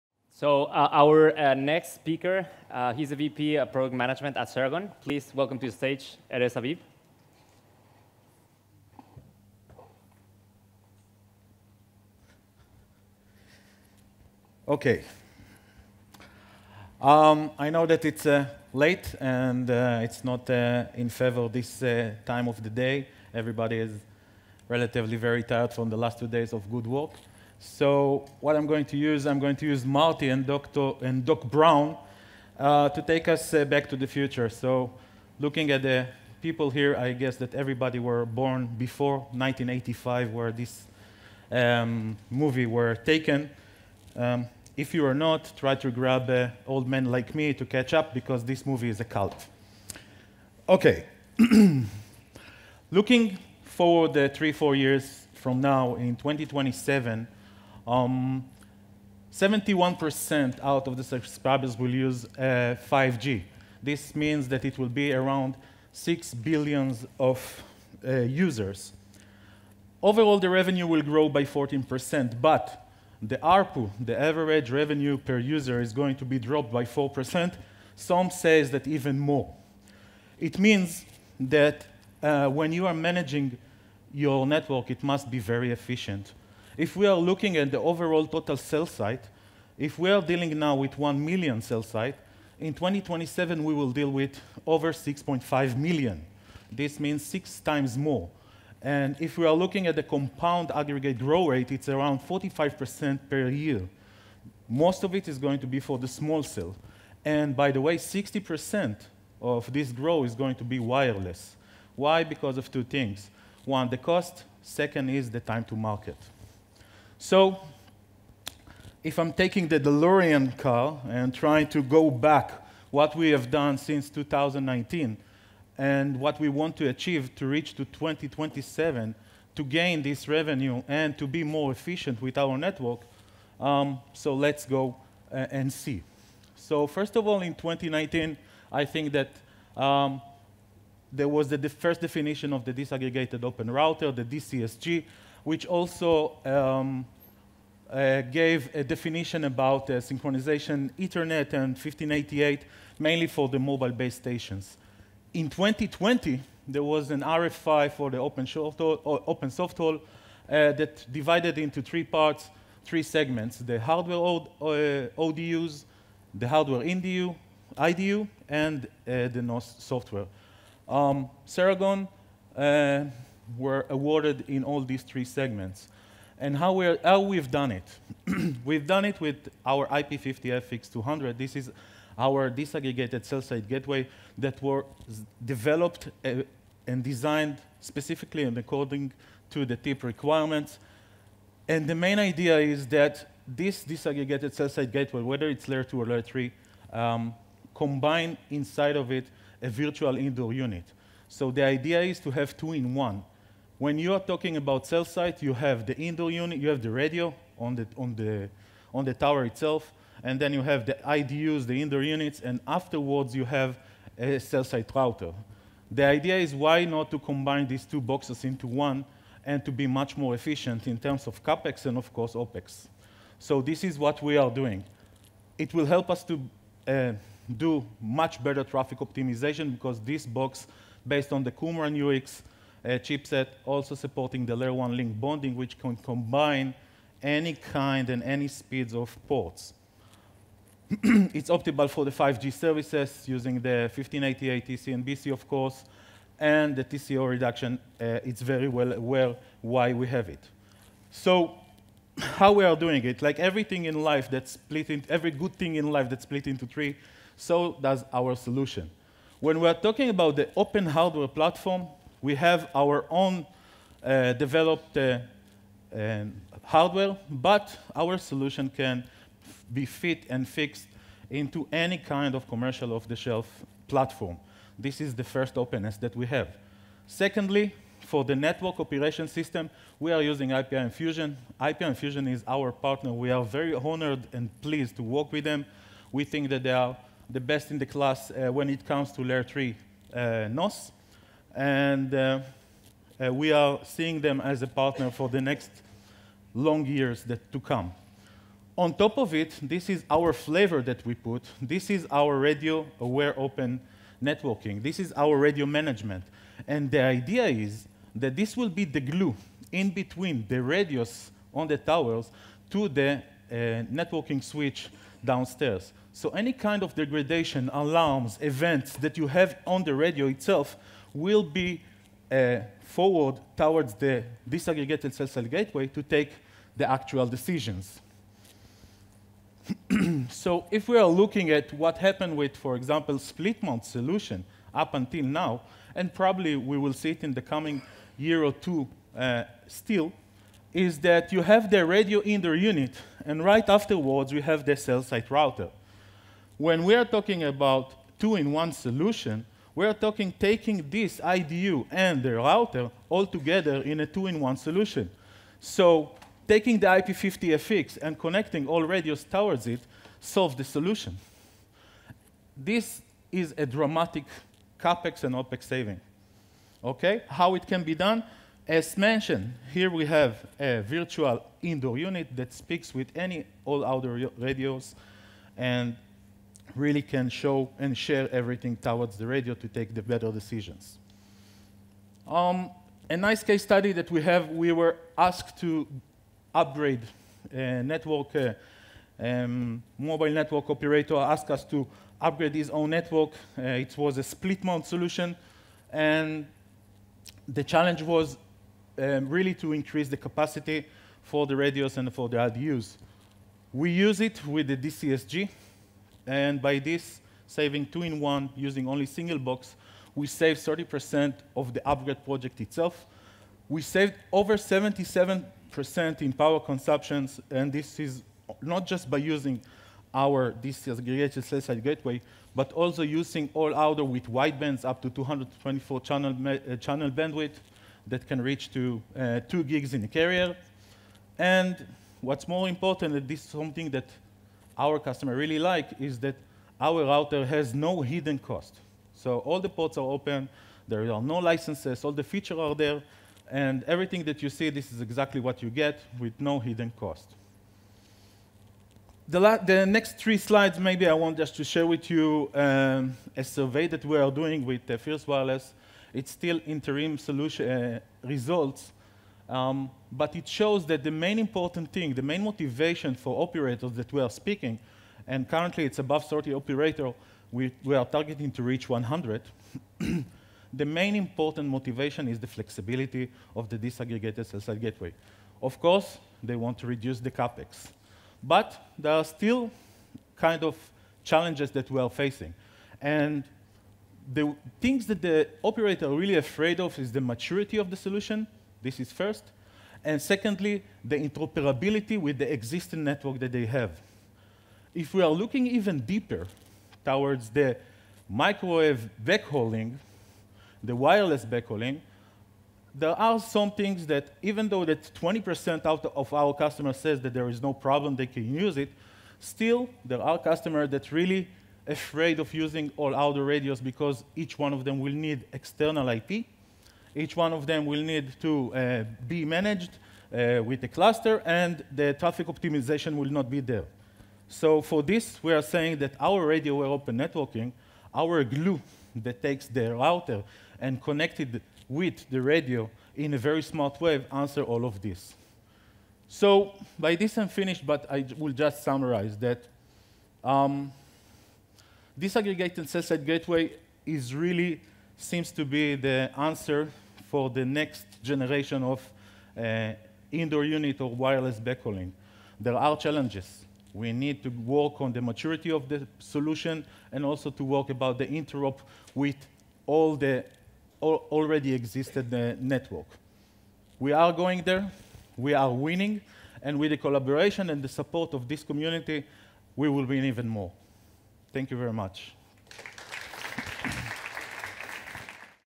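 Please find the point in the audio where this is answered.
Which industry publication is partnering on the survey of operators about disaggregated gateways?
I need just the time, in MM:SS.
07:34.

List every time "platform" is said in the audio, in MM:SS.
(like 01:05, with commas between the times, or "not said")
04:21, 04:33.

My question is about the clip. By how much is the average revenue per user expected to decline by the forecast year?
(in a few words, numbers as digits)
4%.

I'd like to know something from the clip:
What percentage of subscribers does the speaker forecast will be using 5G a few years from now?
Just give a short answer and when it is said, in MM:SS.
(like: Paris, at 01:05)
71%, at 00:59.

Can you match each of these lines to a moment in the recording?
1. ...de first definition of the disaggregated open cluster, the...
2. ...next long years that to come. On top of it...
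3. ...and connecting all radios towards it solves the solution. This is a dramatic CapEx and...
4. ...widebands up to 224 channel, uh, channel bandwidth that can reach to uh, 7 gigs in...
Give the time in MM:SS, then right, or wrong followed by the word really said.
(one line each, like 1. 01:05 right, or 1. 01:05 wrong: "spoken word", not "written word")
1. 02:21 wrong: "router", not "cluster"
2. 04:55 right
3. 05:58 right
4. 07:04 wrong: "2", not "7".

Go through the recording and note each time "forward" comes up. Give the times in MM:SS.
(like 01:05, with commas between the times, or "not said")
00:53, 05:22.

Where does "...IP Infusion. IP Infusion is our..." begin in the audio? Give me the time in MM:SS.
04:40.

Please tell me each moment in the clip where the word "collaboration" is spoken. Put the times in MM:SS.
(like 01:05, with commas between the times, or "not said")
09:27.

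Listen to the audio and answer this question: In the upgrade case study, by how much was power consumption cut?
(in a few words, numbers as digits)
over 77%.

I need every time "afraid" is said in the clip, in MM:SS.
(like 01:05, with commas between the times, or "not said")
08:06, 08:31.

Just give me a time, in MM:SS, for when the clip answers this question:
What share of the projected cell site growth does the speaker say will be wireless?
01:47.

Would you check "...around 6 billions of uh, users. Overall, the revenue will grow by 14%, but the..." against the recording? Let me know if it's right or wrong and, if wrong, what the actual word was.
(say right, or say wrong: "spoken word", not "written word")
right.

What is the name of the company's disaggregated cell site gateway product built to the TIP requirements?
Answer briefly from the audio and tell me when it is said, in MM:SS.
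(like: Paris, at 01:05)
IP50FX, at 02:59.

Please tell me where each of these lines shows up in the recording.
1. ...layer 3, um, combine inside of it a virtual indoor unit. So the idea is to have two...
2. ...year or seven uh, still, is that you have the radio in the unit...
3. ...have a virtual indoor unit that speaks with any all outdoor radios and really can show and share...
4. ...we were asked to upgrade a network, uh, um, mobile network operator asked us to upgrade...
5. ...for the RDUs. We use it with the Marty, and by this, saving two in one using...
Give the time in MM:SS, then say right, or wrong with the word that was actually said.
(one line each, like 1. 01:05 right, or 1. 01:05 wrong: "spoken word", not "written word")
1. 03:16 right
2. 05:38 wrong: "two", not "seven"
3. 06:10 right
4. 06:24 right
5. 06:42 wrong: "DCSG", not "Marty".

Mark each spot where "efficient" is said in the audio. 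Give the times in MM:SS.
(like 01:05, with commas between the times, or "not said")
01:25, 02:11, 03:40.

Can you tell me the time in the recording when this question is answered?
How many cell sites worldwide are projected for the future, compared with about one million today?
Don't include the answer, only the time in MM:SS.
01:34.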